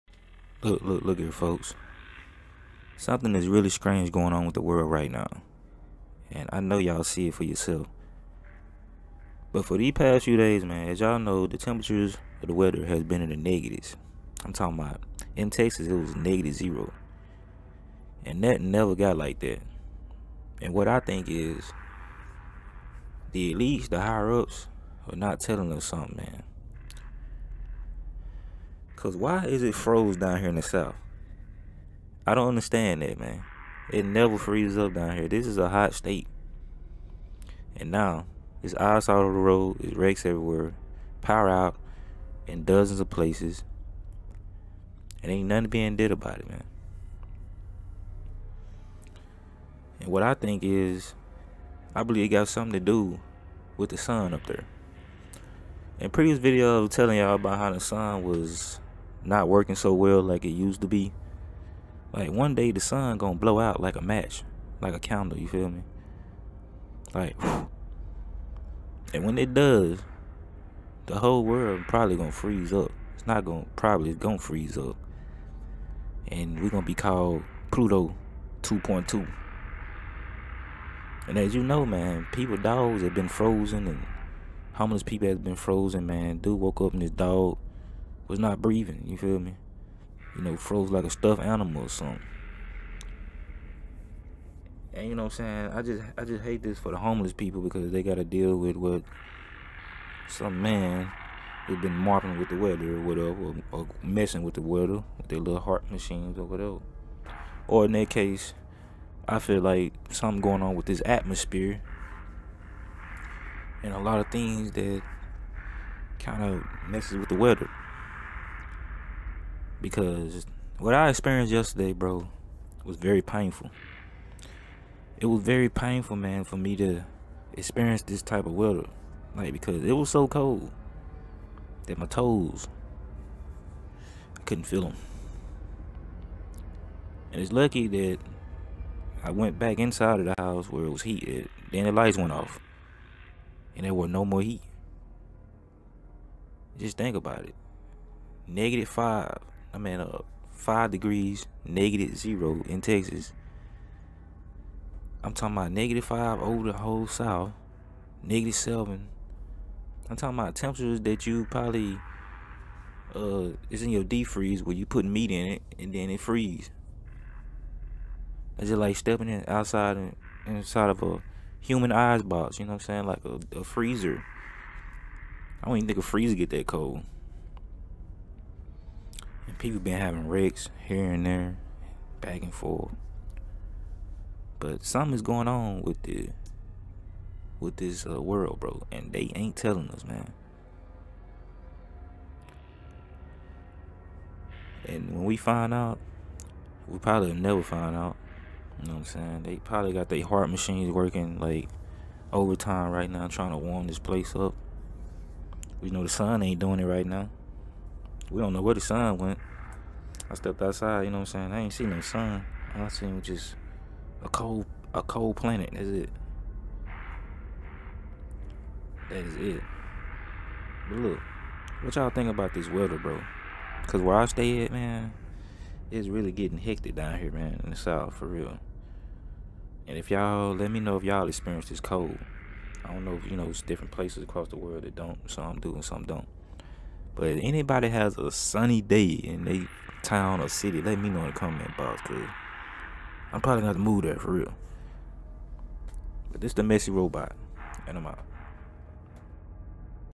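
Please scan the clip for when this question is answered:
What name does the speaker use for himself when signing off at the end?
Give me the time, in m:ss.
4:06.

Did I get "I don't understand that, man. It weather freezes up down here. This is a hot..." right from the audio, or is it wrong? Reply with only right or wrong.
wrong.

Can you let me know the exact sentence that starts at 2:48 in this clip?
It's just like stepping in outside inside of a human eyes box, you know what I'm saying?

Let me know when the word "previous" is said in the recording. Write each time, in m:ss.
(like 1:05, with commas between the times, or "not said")
0:56.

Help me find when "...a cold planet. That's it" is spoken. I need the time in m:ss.
3:34.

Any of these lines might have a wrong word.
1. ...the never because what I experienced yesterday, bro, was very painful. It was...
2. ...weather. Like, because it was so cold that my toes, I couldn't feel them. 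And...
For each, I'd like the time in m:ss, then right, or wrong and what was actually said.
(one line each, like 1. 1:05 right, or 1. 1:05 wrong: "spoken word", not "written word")
1. 1:57 wrong: "weather", not "never"
2. 2:08 right.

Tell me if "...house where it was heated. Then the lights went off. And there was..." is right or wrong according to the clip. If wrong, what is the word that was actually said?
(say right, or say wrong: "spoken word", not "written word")
right.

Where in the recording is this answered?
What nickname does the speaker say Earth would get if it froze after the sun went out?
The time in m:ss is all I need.
1:17.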